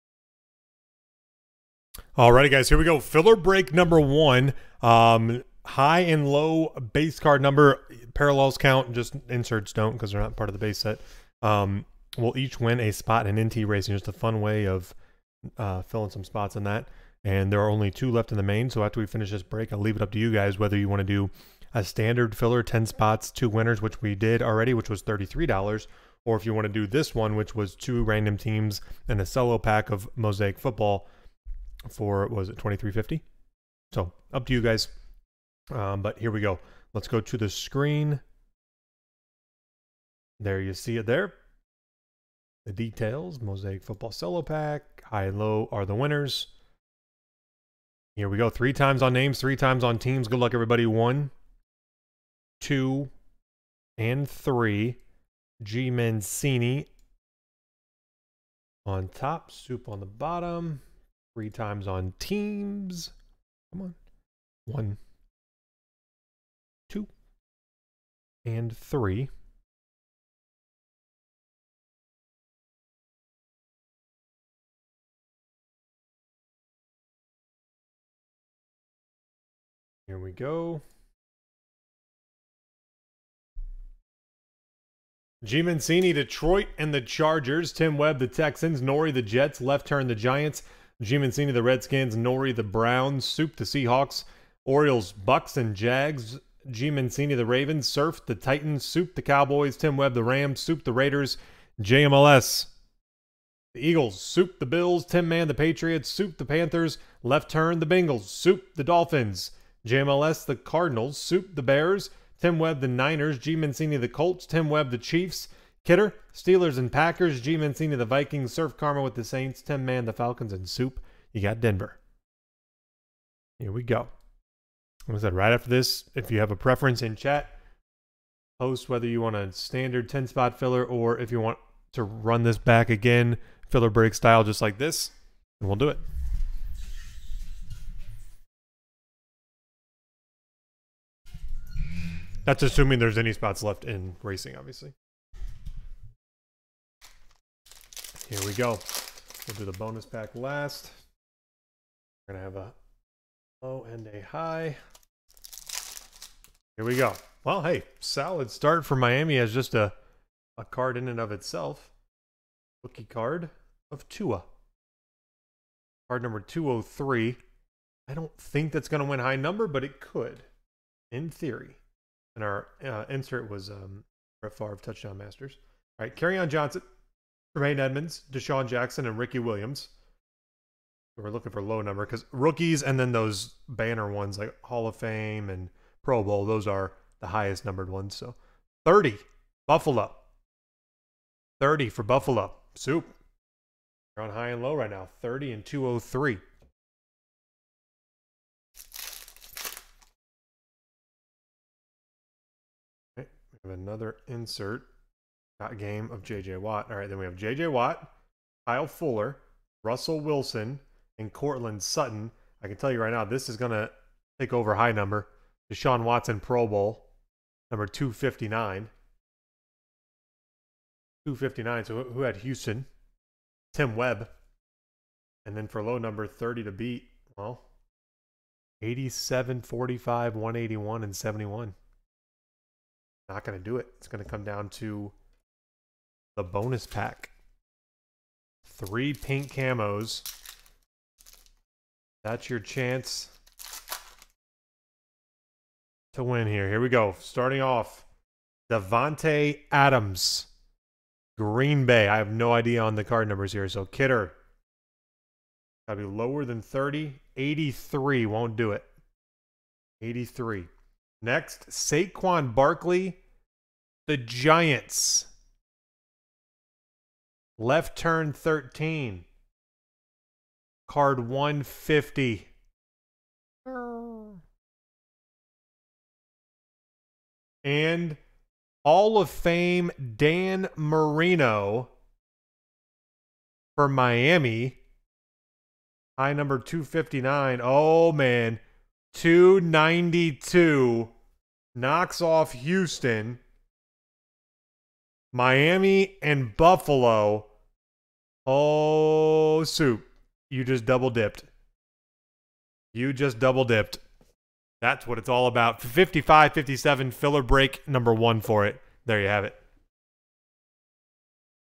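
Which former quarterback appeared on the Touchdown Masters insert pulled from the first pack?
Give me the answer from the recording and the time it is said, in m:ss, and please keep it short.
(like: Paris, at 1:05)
Brett Favre, at 2:54.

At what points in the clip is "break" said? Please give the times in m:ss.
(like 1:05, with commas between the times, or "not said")
0:03, 0:19, 2:13, 5:07.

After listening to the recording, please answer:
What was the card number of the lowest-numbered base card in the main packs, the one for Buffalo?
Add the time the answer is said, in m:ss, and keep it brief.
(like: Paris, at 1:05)
30, at 3:08.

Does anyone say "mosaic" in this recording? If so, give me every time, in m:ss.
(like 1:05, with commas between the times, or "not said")
0:30, 0:43.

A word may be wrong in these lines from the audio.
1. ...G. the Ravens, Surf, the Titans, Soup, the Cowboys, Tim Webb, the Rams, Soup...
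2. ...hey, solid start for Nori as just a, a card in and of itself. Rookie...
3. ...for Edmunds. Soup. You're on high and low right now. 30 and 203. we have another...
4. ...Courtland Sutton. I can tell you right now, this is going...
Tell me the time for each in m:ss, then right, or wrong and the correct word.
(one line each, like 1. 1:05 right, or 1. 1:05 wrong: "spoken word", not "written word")
1. 1:36 right
2. 2:37 wrong: "Miami", not "Nori"
3. 3:11 wrong: "Buffalo", not "Edmunds"
4. 3:31 right.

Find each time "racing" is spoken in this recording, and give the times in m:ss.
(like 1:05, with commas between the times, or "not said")
0:13, 2:24.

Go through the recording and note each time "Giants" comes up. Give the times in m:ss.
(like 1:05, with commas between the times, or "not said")
1:30, 4:24.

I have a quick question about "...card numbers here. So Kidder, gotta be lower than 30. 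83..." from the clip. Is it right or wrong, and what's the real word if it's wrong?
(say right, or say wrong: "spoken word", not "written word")
right.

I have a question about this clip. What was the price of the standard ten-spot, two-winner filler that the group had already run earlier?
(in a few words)
$33.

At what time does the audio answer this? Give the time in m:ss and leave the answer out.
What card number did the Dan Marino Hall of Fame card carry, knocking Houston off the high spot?
4:49.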